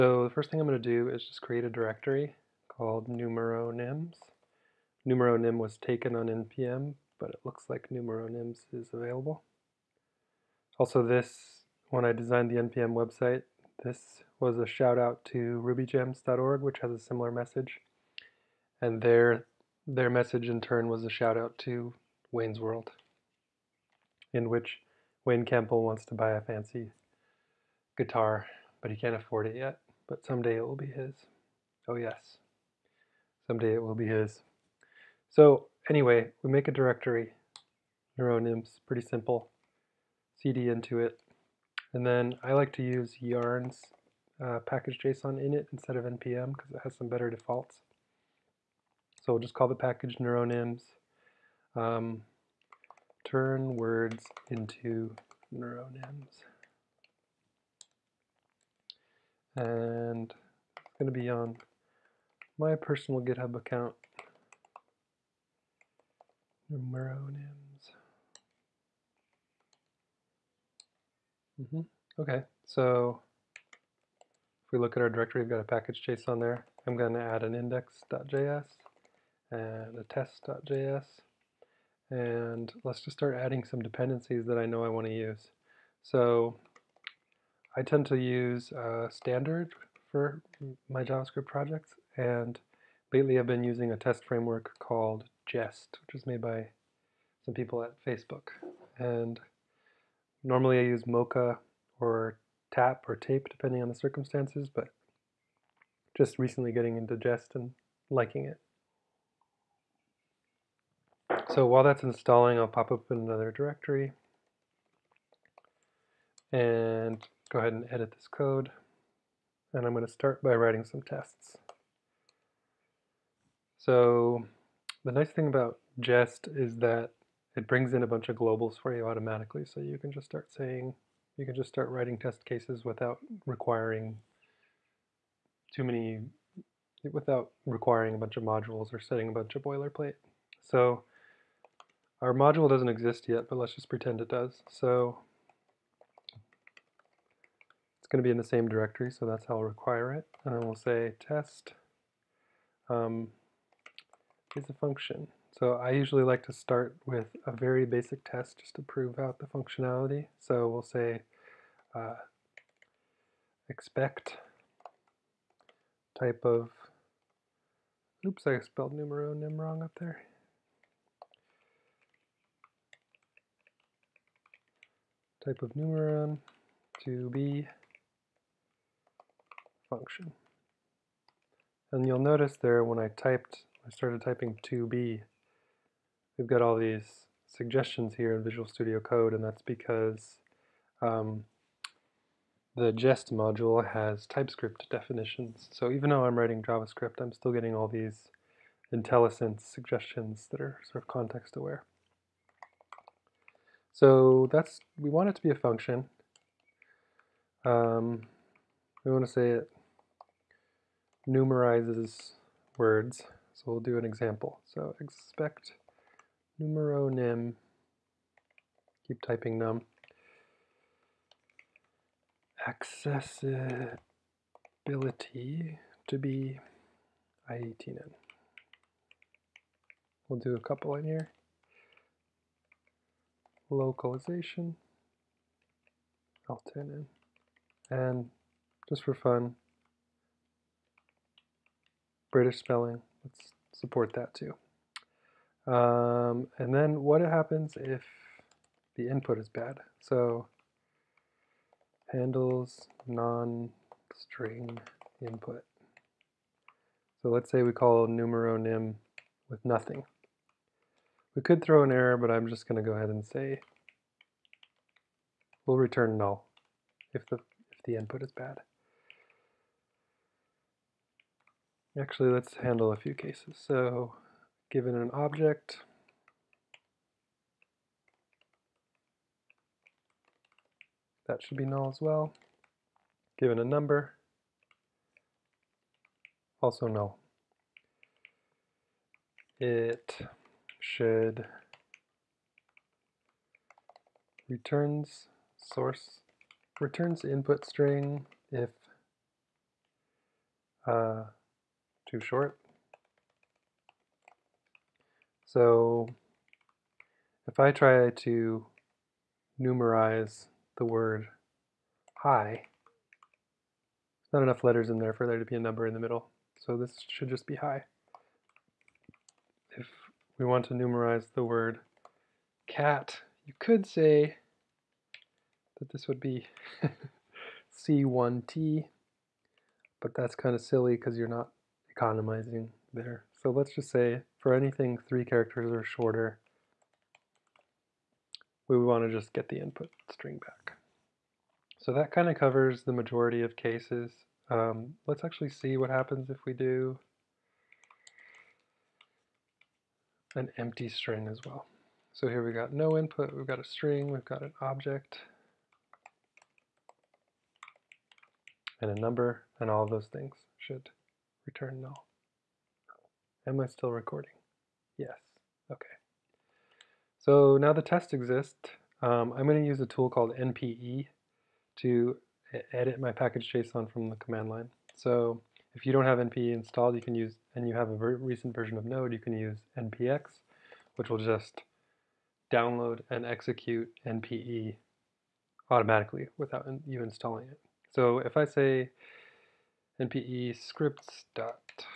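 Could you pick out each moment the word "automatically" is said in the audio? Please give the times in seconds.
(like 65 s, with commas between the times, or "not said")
129 s, 385 s.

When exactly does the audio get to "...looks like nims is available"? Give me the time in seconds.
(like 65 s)
7 s.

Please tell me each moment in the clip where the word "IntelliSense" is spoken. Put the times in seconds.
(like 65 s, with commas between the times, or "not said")
198 s.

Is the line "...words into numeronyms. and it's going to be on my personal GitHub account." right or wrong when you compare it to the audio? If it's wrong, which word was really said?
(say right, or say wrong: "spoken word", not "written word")
right.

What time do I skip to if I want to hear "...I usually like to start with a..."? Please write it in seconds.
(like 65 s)
155 s.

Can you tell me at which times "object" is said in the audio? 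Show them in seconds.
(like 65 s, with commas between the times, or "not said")
275 s, 354 s.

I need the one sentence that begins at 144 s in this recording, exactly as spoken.
So it's going to be in the same directory, so that's how I'll require it.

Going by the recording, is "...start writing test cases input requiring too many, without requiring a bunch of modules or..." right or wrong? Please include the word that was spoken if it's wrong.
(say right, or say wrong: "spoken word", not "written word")
wrong: "without", not "input".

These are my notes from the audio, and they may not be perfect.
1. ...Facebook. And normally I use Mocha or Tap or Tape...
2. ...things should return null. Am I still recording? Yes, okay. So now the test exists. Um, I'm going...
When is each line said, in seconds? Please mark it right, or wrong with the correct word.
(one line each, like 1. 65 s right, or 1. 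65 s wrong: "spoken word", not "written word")
1. 98 s right
2. 360 s right.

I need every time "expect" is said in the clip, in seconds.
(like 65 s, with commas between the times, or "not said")
163 s, 214 s.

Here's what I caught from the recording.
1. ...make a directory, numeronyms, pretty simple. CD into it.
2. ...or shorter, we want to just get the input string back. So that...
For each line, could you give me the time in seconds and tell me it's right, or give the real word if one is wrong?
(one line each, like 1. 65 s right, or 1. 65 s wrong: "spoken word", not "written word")
1. 36 s right
2. 335 s right.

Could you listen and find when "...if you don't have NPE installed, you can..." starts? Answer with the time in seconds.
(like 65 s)
375 s.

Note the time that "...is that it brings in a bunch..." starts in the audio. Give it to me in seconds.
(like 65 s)
126 s.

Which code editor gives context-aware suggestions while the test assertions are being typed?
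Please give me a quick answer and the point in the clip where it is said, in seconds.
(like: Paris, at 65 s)
Visual Studio Code, at 188 s.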